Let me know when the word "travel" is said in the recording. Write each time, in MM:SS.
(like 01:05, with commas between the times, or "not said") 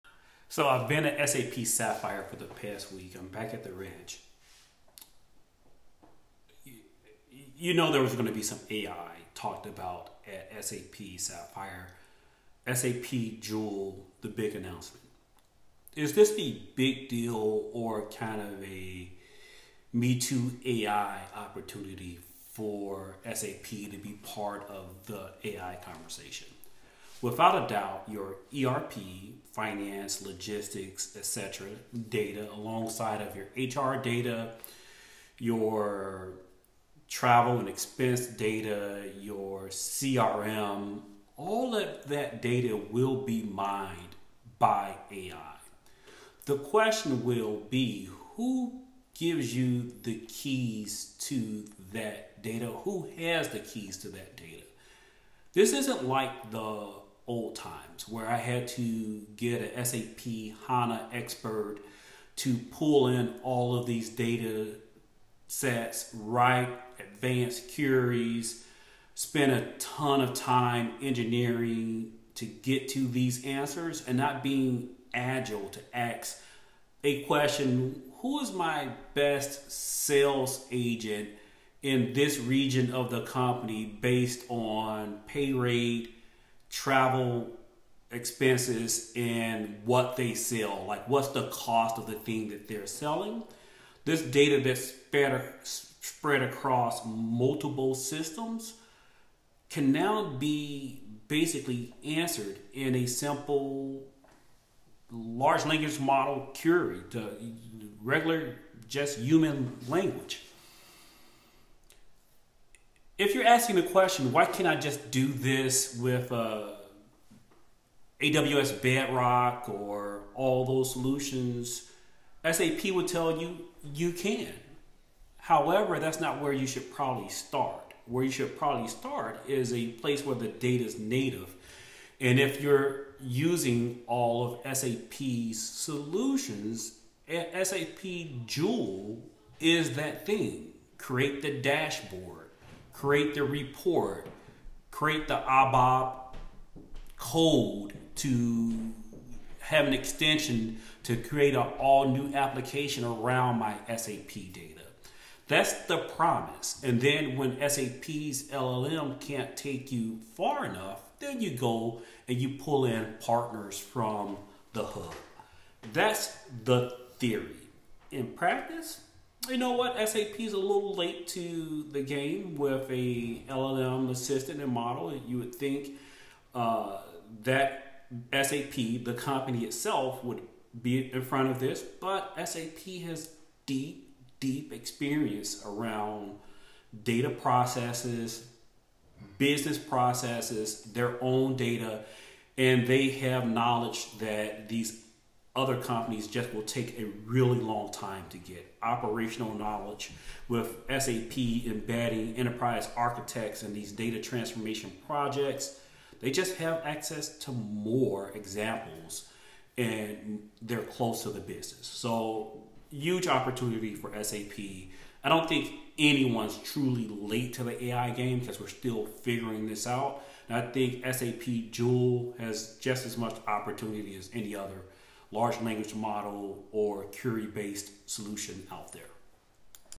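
00:37, 01:26.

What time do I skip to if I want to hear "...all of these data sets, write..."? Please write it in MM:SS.
01:03.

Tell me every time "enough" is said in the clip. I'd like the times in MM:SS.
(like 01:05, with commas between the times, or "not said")
02:40.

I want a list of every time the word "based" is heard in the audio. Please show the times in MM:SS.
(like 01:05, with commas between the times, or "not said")
01:23, 03:47.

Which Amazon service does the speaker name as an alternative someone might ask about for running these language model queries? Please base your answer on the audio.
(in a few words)
AWS Bedrock.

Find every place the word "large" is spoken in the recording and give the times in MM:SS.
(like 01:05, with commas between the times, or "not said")
01:45, 03:45.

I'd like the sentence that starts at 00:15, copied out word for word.
Is this the big deal or kind of a Me Too AI opportunity for SAP to be part of the AI conversation?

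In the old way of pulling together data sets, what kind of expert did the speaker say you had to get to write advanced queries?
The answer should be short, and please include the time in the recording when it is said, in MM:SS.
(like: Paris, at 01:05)
SAP HANA expert, at 00:59.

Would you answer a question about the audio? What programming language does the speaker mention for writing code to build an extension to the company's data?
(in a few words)
ABAP.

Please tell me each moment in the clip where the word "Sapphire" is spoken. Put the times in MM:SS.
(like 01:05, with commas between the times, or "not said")
00:01, 00:11.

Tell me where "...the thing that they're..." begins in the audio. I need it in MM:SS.
01:32.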